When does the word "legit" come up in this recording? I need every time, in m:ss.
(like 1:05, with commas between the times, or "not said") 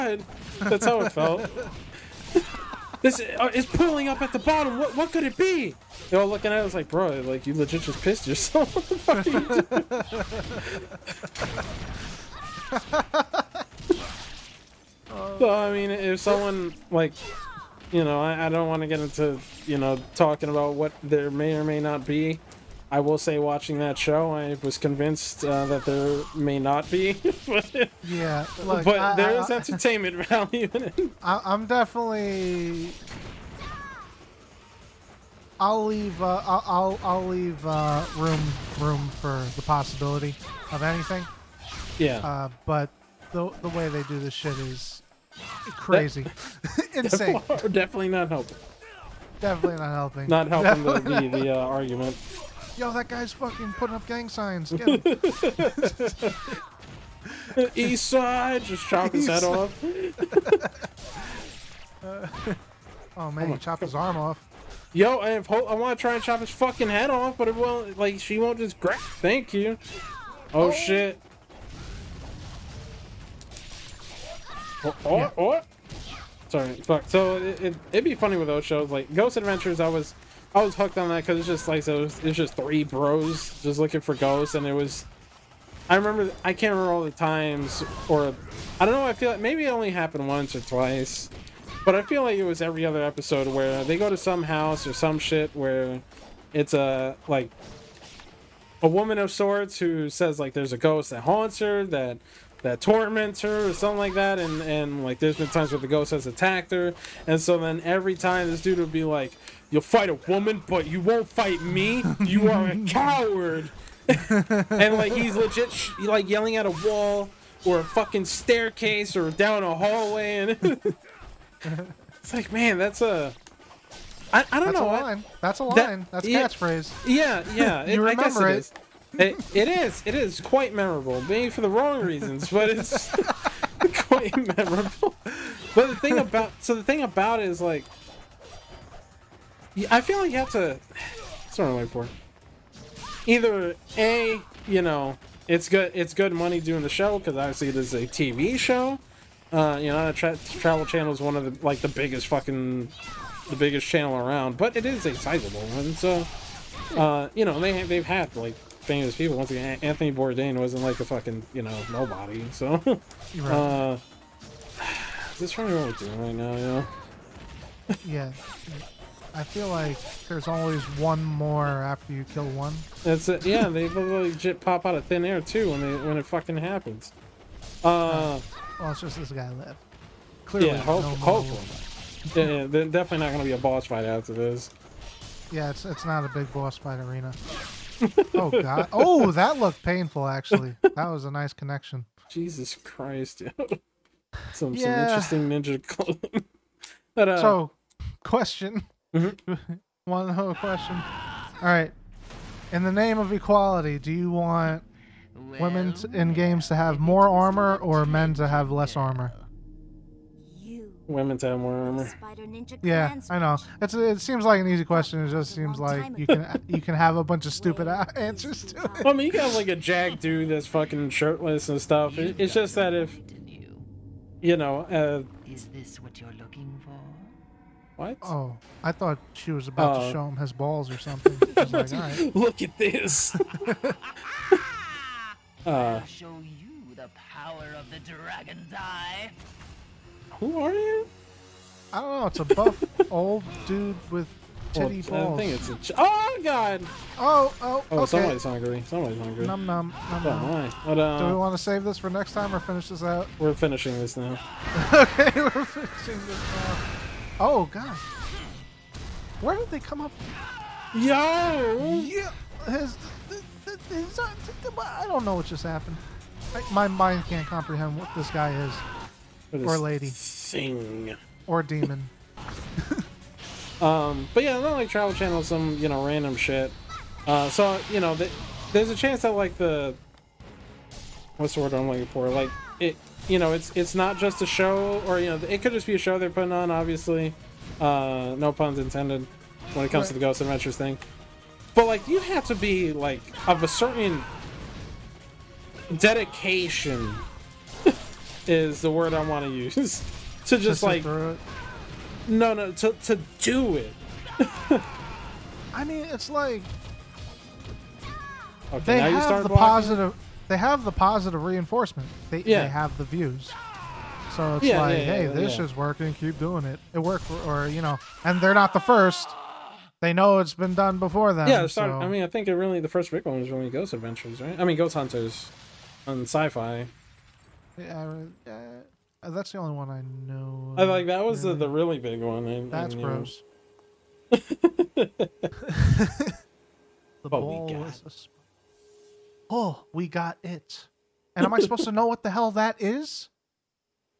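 0:07, 1:55, 2:53.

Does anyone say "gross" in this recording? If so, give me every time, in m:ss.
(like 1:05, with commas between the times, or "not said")
5:32.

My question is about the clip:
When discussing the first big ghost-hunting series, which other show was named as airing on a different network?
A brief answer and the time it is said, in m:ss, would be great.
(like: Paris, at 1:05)
Ghost Hunters, at 5:24.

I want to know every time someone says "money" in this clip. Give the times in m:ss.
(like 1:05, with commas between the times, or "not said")
2:26.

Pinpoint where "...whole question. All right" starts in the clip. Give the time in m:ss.
3:20.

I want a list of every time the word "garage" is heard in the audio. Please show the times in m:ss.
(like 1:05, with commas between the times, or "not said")
not said.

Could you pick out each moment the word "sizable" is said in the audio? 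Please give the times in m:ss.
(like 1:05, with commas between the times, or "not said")
2:35.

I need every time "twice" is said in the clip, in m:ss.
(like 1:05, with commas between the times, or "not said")
1:30.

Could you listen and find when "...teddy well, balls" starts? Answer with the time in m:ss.
4:04.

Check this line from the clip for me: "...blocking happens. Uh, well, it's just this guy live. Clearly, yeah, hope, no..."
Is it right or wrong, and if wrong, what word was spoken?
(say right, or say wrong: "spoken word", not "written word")
wrong: "fucking", not "blocking".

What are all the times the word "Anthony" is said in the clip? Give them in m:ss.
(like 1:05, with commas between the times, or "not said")
2:39.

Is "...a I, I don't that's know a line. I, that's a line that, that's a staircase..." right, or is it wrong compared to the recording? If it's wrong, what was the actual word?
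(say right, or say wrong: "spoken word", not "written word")
wrong: "catchphrase", not "staircase".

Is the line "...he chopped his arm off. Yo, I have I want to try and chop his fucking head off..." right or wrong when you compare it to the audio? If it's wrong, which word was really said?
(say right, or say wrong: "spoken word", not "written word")
right.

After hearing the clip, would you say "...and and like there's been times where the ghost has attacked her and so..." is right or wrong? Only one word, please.
right.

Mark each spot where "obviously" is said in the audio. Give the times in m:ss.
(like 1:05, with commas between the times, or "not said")
2:27, 4:46.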